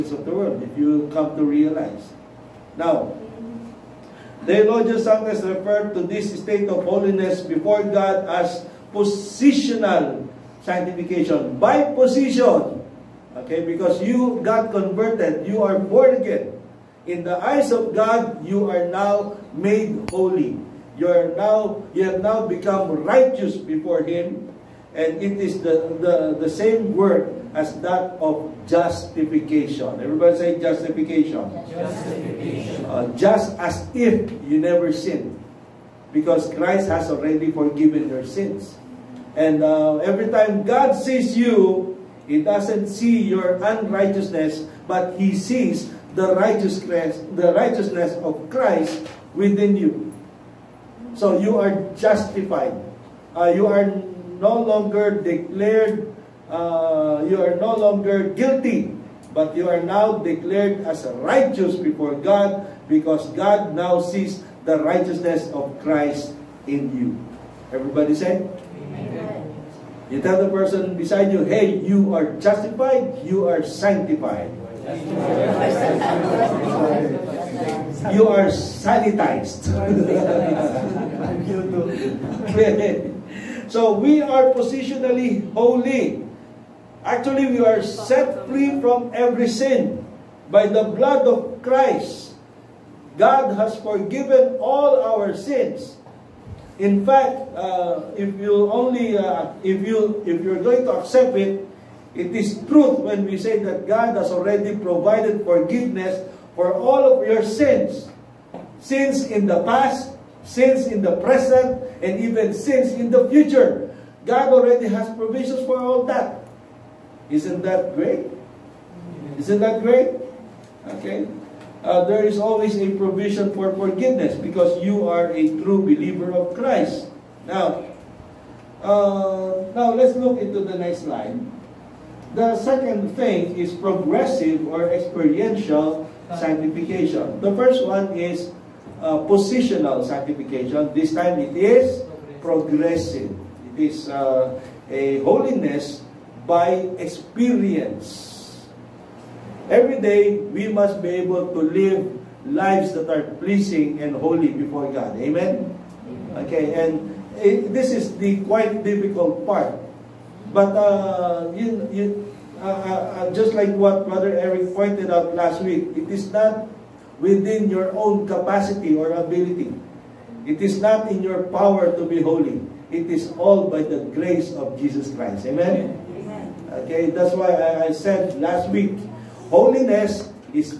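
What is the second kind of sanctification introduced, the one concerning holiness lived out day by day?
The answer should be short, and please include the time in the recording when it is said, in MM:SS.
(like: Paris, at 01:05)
Progressive or experiential sanctification, at 02:13.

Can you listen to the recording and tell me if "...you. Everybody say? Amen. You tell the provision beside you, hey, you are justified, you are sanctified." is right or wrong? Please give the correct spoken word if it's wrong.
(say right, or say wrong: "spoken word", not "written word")
wrong: "person", not "provision".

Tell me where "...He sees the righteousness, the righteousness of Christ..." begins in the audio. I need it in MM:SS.
00:45.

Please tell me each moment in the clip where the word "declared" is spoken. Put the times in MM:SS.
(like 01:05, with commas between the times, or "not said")
00:55, 01:00.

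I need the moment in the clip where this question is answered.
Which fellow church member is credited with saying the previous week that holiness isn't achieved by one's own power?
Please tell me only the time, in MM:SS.
02:44.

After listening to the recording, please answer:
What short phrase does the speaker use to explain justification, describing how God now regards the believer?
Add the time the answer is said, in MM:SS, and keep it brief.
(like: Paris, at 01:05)
Just as if you never sinned, at 00:33.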